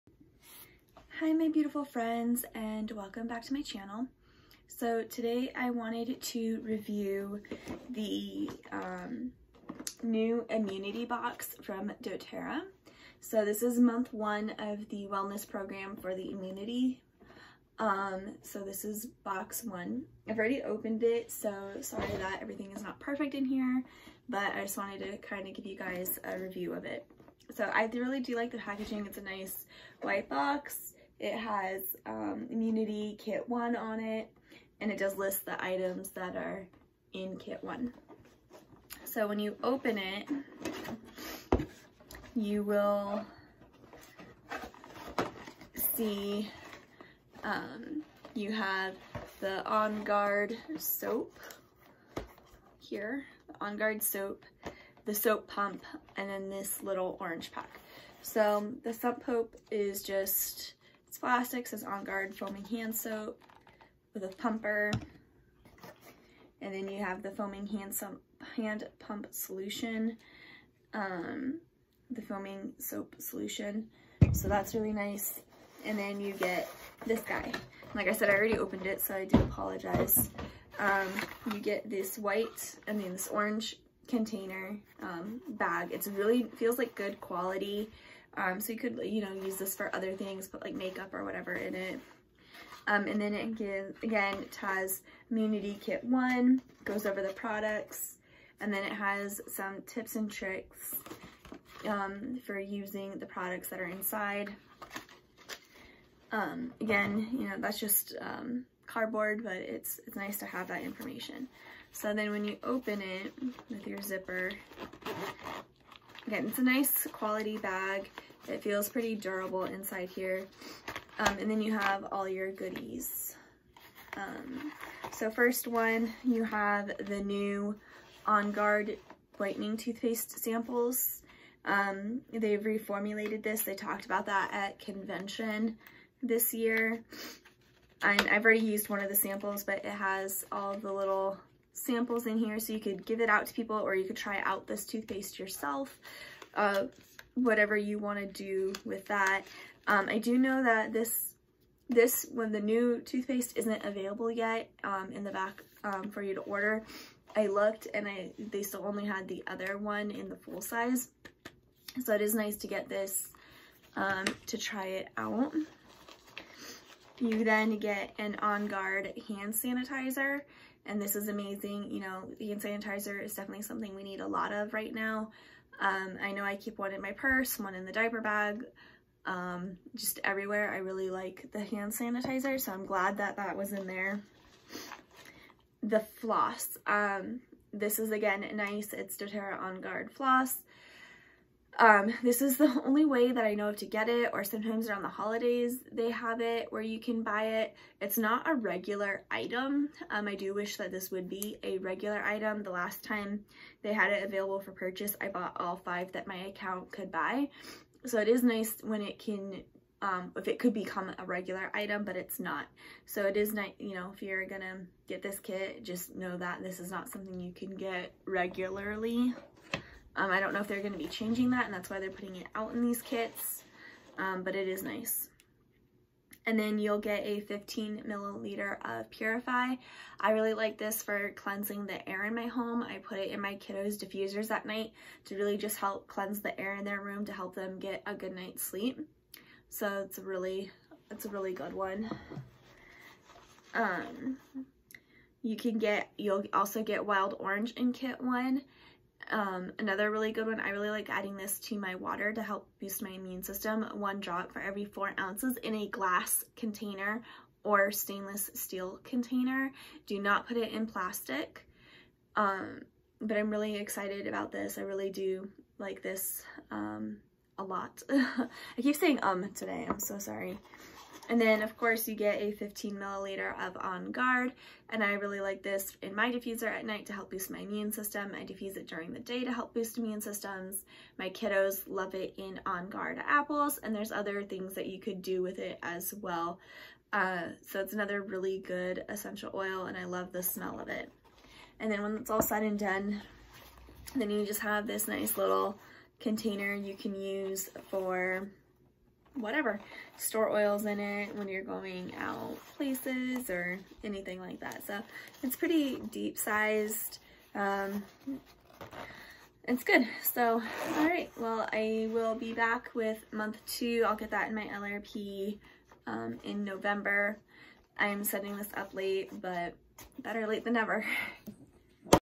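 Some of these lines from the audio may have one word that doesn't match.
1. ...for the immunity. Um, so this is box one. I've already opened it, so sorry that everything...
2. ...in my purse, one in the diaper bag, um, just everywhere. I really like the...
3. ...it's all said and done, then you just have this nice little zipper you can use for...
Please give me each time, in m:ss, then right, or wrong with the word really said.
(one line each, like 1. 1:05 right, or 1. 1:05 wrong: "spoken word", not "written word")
1. 0:15 right
2. 2:56 right
3. 4:52 wrong: "container", not "zipper".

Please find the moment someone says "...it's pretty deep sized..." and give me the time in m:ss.
5:05.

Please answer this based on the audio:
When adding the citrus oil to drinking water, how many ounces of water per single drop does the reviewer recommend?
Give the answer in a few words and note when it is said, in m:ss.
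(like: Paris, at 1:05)
4, at 4:14.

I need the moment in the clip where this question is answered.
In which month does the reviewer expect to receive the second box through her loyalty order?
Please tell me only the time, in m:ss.
5:16.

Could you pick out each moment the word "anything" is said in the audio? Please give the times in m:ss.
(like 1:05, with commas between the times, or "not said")
5:04.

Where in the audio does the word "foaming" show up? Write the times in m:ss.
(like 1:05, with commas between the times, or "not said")
1:02, 1:07, 1:12.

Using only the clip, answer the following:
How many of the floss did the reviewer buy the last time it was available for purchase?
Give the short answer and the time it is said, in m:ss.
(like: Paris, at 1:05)
5, at 3:25.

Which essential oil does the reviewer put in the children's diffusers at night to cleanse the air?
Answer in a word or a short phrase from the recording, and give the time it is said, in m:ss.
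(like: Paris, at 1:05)
Purify, at 3:49.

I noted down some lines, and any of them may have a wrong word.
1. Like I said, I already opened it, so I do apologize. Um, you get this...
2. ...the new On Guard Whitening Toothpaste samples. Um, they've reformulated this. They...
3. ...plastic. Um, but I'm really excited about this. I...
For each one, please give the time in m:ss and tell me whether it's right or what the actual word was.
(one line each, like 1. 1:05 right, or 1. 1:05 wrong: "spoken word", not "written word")
1. 1:17 right
2. 2:07 right
3. 4:20 right.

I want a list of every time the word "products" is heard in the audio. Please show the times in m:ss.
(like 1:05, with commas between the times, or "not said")
1:37, 1:43.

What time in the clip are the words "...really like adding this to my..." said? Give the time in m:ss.
4:10.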